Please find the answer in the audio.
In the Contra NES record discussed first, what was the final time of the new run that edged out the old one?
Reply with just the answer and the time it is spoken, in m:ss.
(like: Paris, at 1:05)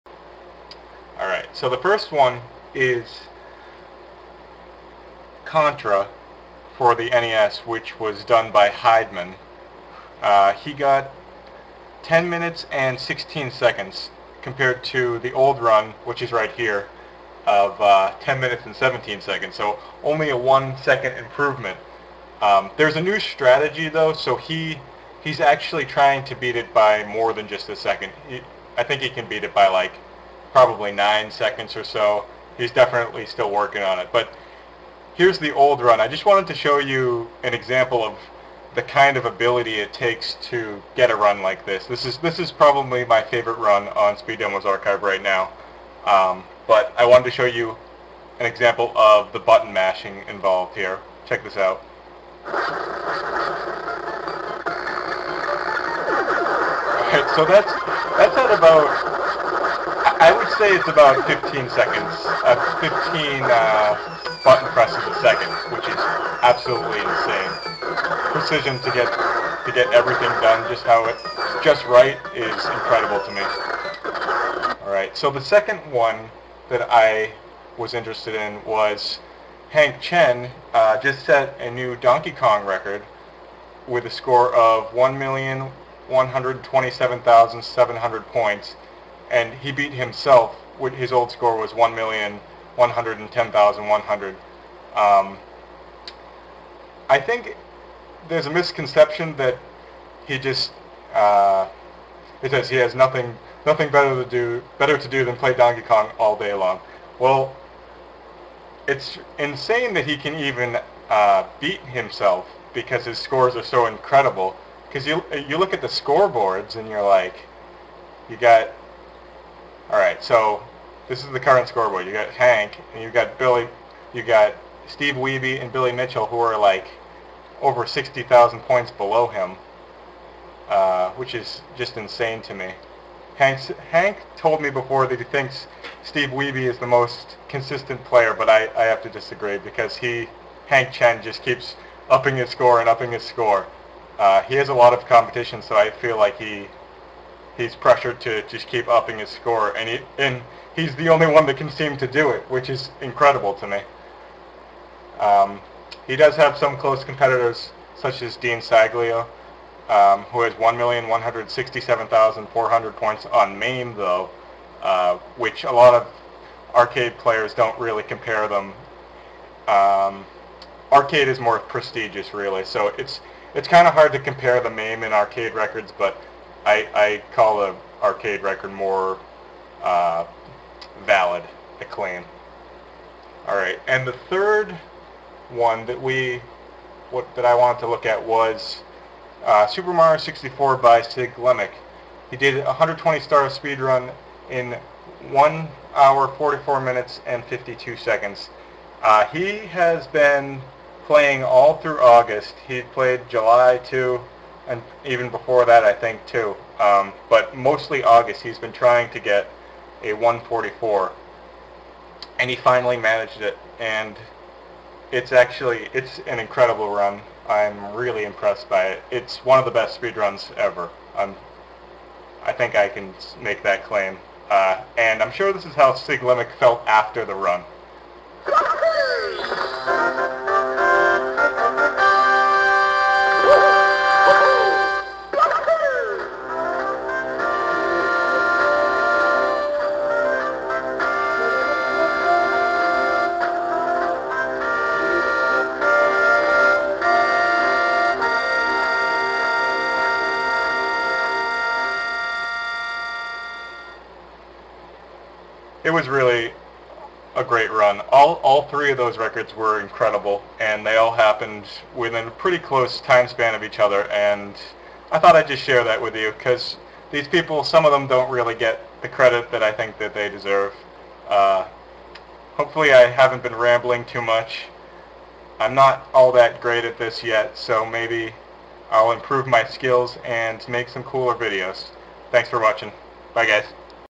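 10 minutes 16 seconds, at 0:12.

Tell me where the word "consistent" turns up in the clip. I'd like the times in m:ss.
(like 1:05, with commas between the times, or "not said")
2:17.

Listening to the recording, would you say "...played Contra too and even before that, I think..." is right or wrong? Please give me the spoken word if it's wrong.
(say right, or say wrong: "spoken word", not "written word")
wrong: "July", not "Contra".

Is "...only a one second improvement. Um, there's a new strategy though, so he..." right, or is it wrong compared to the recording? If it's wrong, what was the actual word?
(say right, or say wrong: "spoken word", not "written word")
right.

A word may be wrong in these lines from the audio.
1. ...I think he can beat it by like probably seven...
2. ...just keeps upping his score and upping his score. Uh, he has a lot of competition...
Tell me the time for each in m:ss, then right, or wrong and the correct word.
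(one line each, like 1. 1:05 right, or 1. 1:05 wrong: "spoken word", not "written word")
1. 0:28 wrong: "nine", not "seven"
2. 2:21 right.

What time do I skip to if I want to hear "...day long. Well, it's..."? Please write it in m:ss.
1:46.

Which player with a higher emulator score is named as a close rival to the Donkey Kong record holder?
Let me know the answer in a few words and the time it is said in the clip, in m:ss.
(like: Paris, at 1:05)
Dean Saglio, at 2:38.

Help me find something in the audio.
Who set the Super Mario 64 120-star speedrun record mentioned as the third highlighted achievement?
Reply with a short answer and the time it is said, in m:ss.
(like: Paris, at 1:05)
Siglemic, at 3:11.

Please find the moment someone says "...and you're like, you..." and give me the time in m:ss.
1:56.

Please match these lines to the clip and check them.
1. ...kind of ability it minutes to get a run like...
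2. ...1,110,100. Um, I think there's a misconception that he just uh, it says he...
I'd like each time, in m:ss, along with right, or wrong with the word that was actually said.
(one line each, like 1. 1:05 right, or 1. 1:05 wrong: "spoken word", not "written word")
1. 0:38 wrong: "takes", not "minutes"
2. 1:31 right.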